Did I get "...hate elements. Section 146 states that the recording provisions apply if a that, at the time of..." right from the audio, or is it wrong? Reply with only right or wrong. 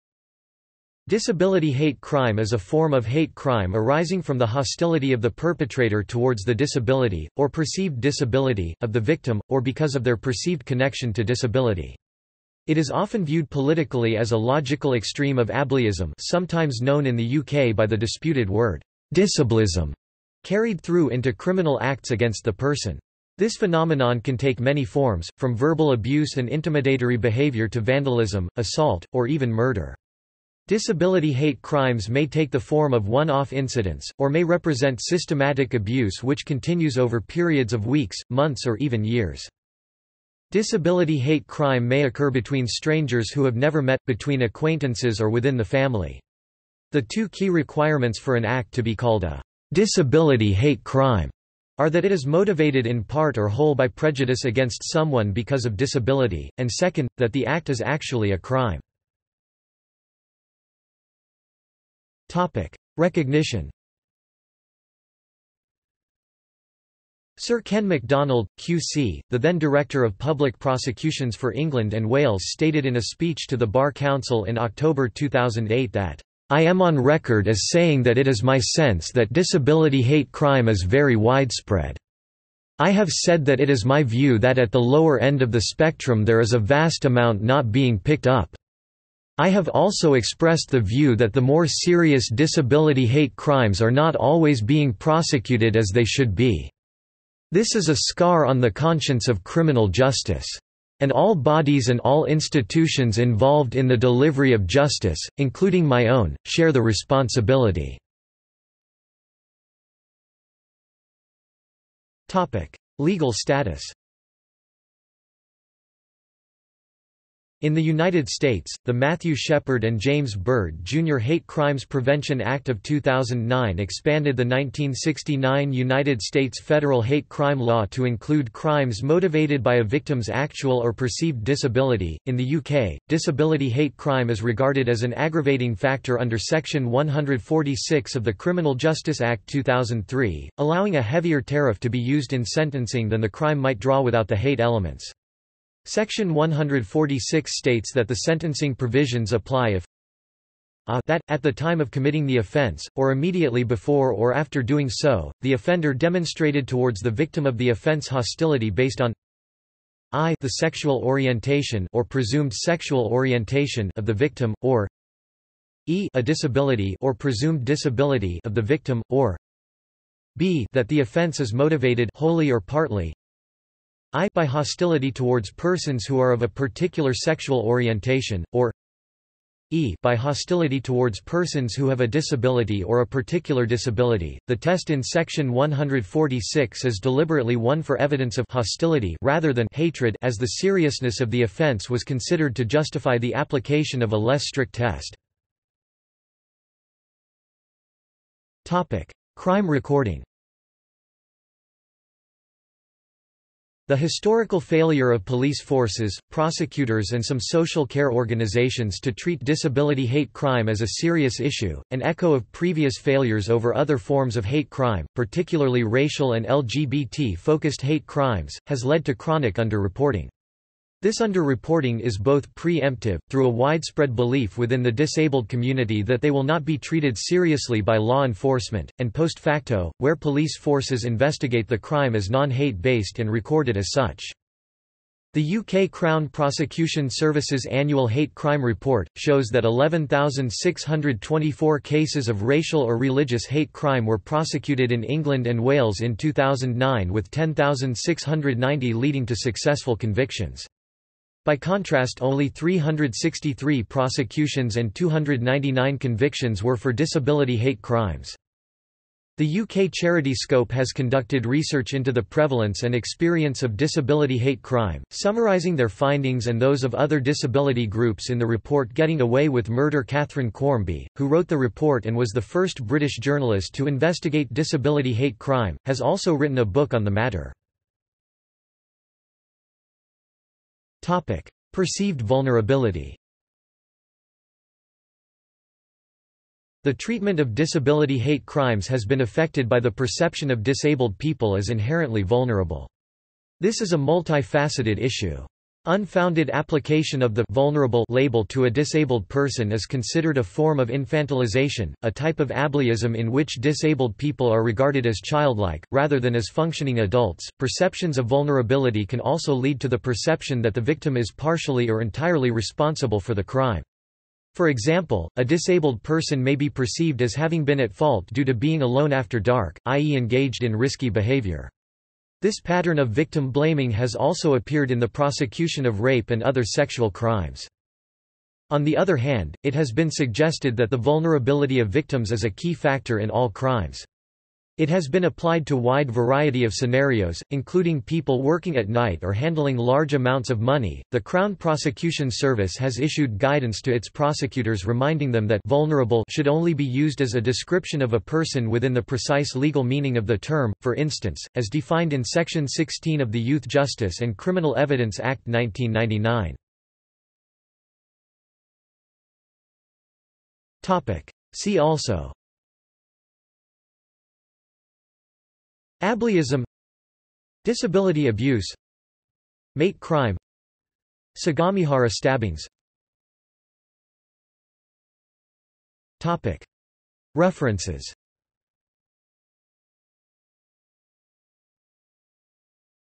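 wrong.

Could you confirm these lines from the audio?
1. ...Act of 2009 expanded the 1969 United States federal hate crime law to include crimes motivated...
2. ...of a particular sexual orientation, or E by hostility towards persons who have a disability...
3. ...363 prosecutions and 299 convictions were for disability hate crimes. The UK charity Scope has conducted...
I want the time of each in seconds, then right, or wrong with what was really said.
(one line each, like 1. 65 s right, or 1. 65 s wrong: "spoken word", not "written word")
1. 122 s right
2. 176 s right
3. 252 s right.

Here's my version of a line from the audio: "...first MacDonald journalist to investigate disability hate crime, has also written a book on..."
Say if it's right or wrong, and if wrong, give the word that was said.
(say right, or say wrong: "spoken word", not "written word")
wrong: "British", not "MacDonald".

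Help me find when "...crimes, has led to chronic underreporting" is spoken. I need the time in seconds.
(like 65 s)
218 s.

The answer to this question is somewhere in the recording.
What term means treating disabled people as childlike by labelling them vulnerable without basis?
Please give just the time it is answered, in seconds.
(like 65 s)
300 s.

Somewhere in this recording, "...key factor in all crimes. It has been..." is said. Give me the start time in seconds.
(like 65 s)
332 s.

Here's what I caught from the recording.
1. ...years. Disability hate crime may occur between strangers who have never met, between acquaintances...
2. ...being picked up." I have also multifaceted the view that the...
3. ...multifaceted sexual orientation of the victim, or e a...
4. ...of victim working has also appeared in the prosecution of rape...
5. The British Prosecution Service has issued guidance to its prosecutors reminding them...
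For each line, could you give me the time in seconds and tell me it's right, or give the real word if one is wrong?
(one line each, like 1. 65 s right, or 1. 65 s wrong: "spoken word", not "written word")
1. 39 s right
2. 87 s wrong: "expressed", not "multifaceted"
3. 162 s wrong: "presumed", not "multifaceted"
4. 322 s wrong: "blaming", not "working"
5. 341 s wrong: "Crown", not "British".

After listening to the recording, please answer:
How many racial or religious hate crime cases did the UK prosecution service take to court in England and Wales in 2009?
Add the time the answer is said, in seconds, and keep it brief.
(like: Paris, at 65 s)
11,624, at 239 s.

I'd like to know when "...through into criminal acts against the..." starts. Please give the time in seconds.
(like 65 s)
20 s.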